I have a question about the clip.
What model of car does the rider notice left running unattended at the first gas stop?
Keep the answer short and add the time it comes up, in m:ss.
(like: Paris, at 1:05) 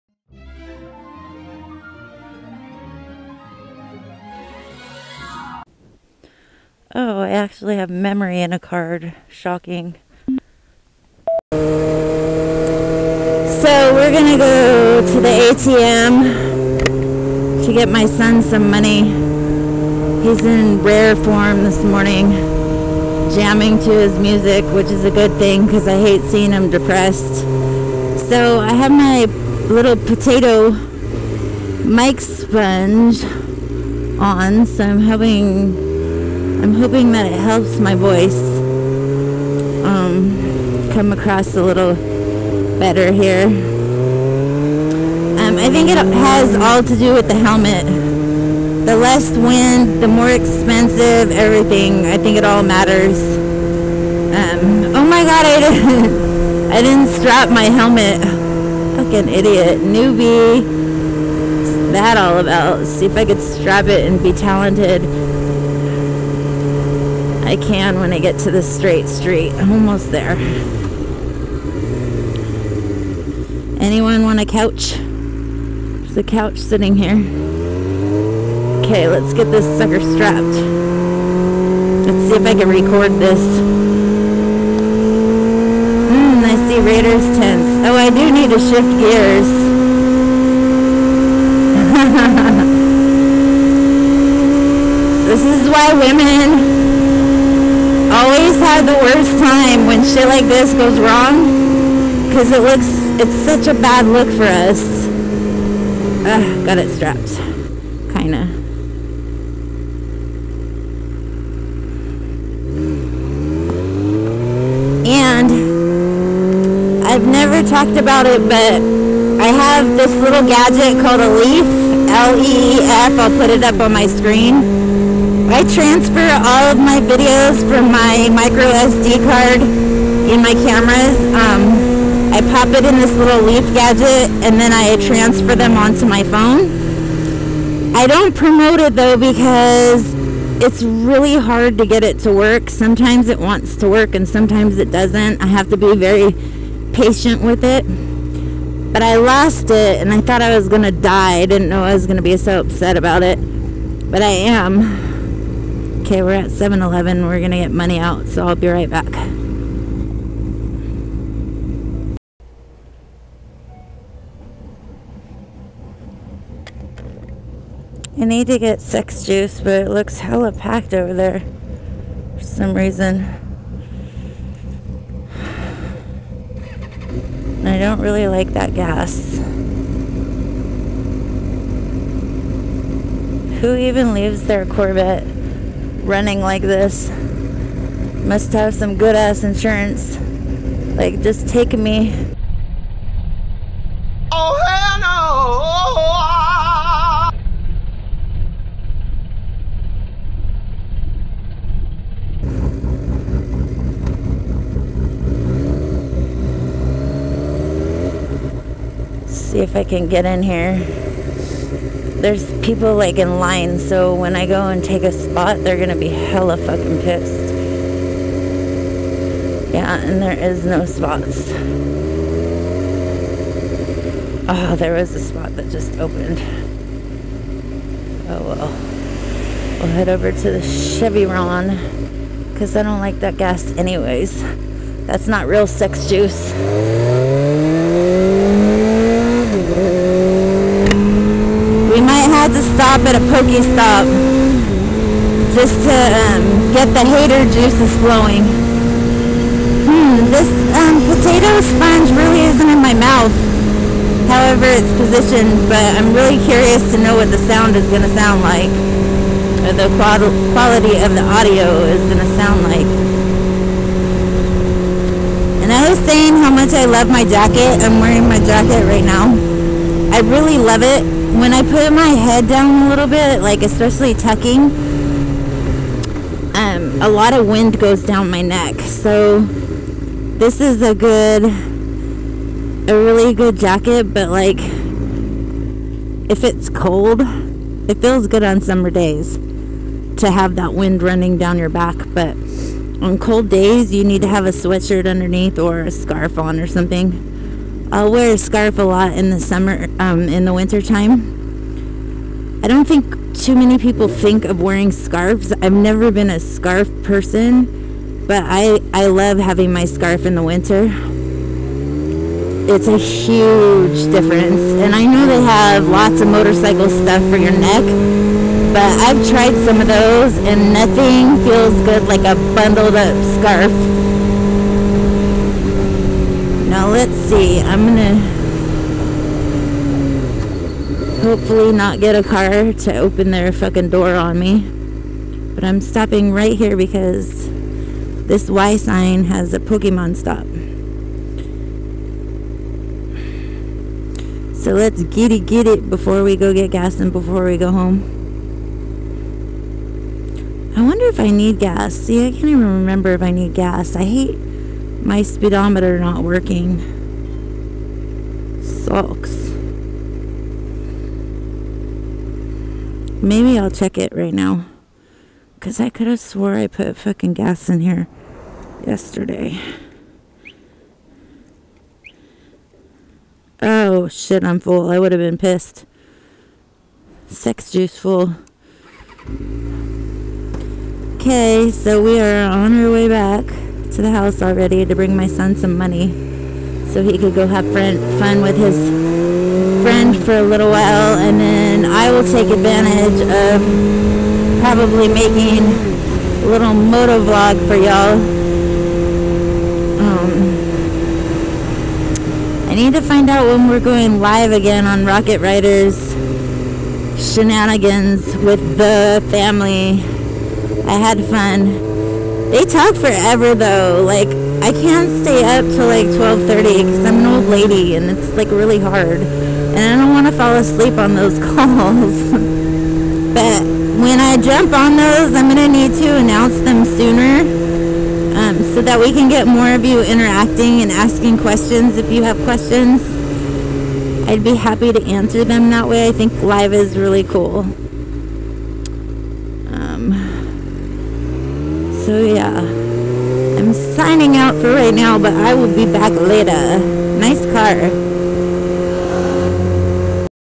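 Corvette, at 3:04.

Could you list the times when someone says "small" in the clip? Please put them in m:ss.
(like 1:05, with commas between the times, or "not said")
not said.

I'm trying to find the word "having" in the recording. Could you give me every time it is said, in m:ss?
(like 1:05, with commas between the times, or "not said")
0:34, 5:09.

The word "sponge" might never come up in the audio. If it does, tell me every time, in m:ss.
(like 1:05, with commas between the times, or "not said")
0:32, 4:11.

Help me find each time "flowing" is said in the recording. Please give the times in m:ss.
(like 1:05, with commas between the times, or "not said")
4:08.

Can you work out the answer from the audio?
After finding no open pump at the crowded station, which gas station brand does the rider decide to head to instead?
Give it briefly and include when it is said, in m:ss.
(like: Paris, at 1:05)
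Chevron, at 3:50.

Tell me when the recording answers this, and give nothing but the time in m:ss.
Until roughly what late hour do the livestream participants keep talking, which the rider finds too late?
6:56.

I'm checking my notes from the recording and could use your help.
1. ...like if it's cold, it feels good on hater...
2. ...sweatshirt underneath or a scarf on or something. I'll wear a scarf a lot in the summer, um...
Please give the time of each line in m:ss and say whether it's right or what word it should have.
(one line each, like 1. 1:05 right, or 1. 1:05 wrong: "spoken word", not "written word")
1. 4:44 wrong: "summer", not "hater"
2. 4:54 right.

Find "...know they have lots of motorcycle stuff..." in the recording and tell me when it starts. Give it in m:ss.
5:15.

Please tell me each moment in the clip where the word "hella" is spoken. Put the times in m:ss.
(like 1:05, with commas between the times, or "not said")
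2:50, 3:36.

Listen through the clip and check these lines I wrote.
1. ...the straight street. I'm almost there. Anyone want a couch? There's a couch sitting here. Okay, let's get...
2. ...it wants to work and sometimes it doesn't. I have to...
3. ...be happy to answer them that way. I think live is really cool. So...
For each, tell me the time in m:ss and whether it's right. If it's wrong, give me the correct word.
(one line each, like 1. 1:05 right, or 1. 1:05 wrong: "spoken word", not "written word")
1. 1:08 right
2. 2:23 right
3. 7:14 right.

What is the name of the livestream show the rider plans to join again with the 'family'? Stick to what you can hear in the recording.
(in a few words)
Rocket Riders.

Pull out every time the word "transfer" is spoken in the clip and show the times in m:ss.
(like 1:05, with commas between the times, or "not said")
2:05, 2:15.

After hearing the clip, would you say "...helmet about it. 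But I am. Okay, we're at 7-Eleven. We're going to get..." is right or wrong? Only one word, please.
wrong.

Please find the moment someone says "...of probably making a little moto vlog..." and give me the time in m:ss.
6:33.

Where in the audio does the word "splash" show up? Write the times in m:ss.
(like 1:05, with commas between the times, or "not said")
not said.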